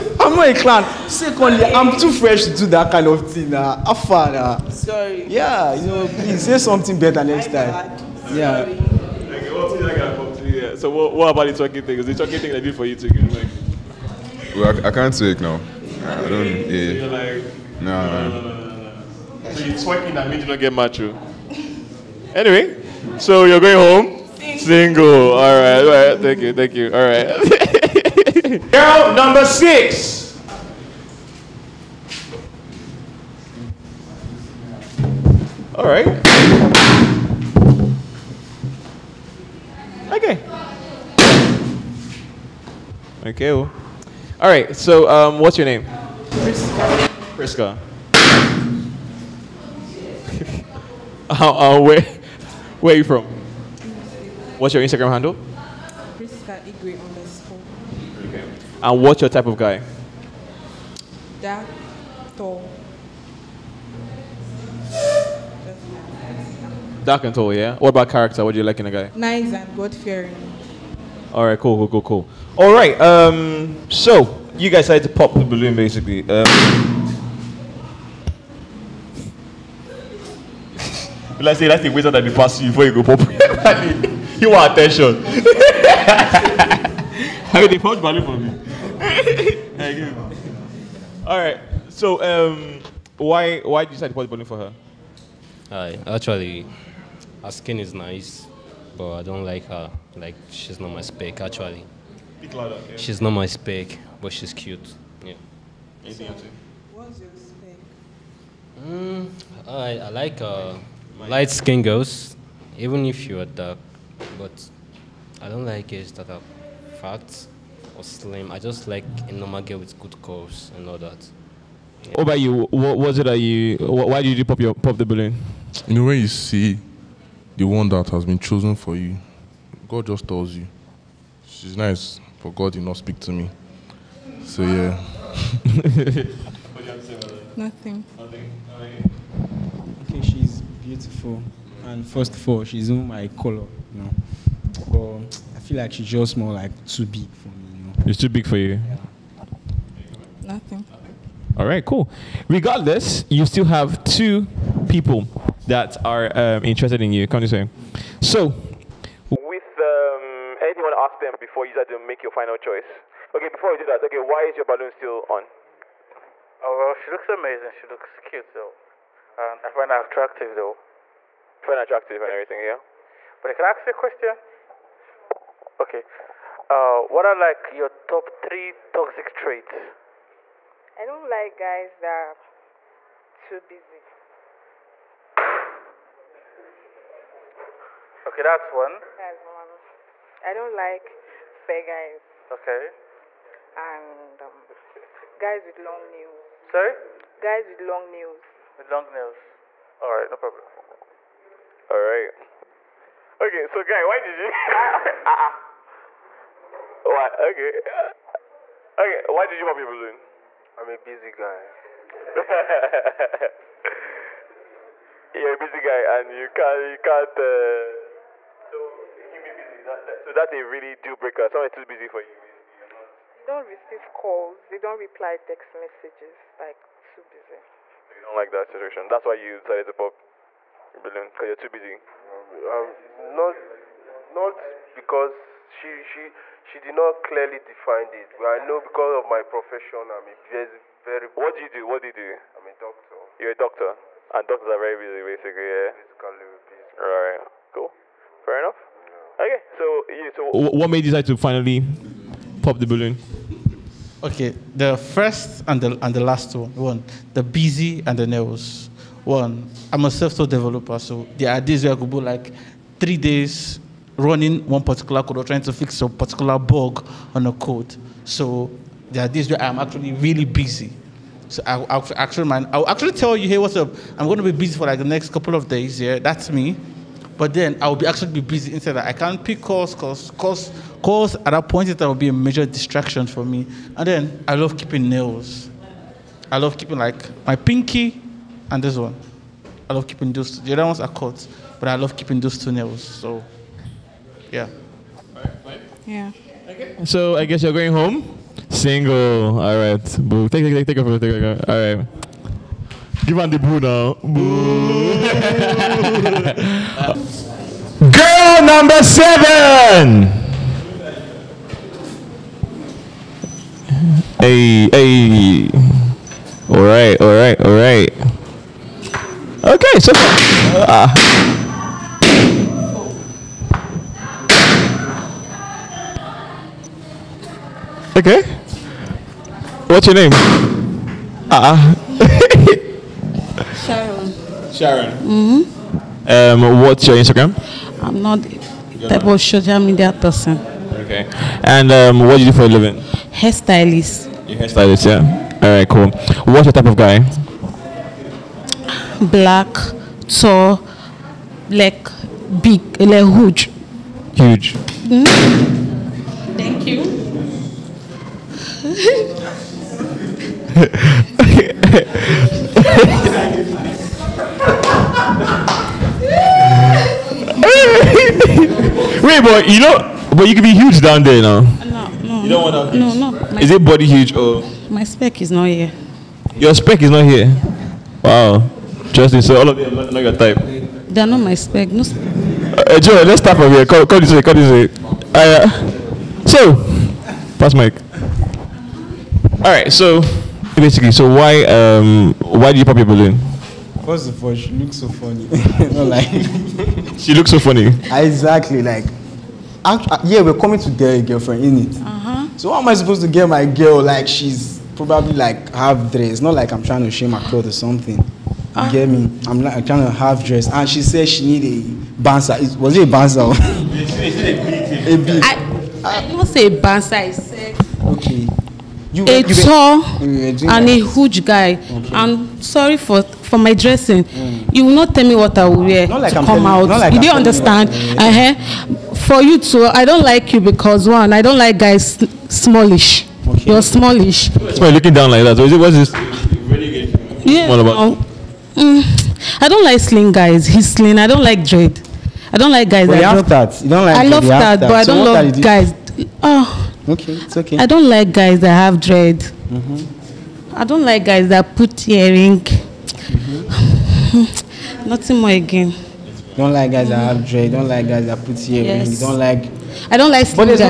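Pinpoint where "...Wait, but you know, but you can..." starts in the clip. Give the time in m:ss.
6:09.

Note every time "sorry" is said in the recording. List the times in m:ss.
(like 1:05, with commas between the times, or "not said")
0:04, 3:16, 7:02.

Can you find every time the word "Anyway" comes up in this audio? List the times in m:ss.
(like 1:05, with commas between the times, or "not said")
0:22.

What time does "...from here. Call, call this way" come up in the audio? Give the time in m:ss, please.
6:23.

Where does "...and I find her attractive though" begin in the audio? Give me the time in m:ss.
2:49.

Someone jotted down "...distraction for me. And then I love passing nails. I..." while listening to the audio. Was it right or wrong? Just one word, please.
wrong.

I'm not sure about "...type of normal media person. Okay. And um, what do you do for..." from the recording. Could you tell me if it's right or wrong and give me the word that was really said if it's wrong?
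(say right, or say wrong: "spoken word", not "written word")
wrong: "social", not "normal".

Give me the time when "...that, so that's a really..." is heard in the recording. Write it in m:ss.
3:40.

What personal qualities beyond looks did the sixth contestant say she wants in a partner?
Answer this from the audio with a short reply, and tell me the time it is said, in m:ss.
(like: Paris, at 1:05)
Nice and God-fearing, at 1:09.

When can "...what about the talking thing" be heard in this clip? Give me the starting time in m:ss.
0:11.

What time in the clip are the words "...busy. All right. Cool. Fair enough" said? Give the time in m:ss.
4:06.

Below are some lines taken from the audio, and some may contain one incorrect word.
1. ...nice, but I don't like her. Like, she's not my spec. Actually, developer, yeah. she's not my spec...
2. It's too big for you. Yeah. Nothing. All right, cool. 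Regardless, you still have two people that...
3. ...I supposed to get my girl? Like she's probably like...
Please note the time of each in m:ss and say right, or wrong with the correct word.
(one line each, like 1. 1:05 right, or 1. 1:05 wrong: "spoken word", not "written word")
1. 1:37 wrong: "louder", not "developer"
2. 2:28 right
3. 6:42 right.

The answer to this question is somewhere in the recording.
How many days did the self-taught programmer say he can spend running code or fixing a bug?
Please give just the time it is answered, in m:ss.
4:22.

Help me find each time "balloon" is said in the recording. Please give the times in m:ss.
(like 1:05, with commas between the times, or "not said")
1:15, 2:05, 2:44, 3:29, 3:51, 4:12, 6:33.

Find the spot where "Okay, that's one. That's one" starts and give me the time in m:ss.
3:08.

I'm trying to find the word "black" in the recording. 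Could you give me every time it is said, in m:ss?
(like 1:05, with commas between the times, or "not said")
5:49.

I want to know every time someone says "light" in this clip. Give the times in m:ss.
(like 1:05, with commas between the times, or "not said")
1:51.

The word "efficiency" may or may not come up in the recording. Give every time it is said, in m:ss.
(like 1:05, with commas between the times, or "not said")
not said.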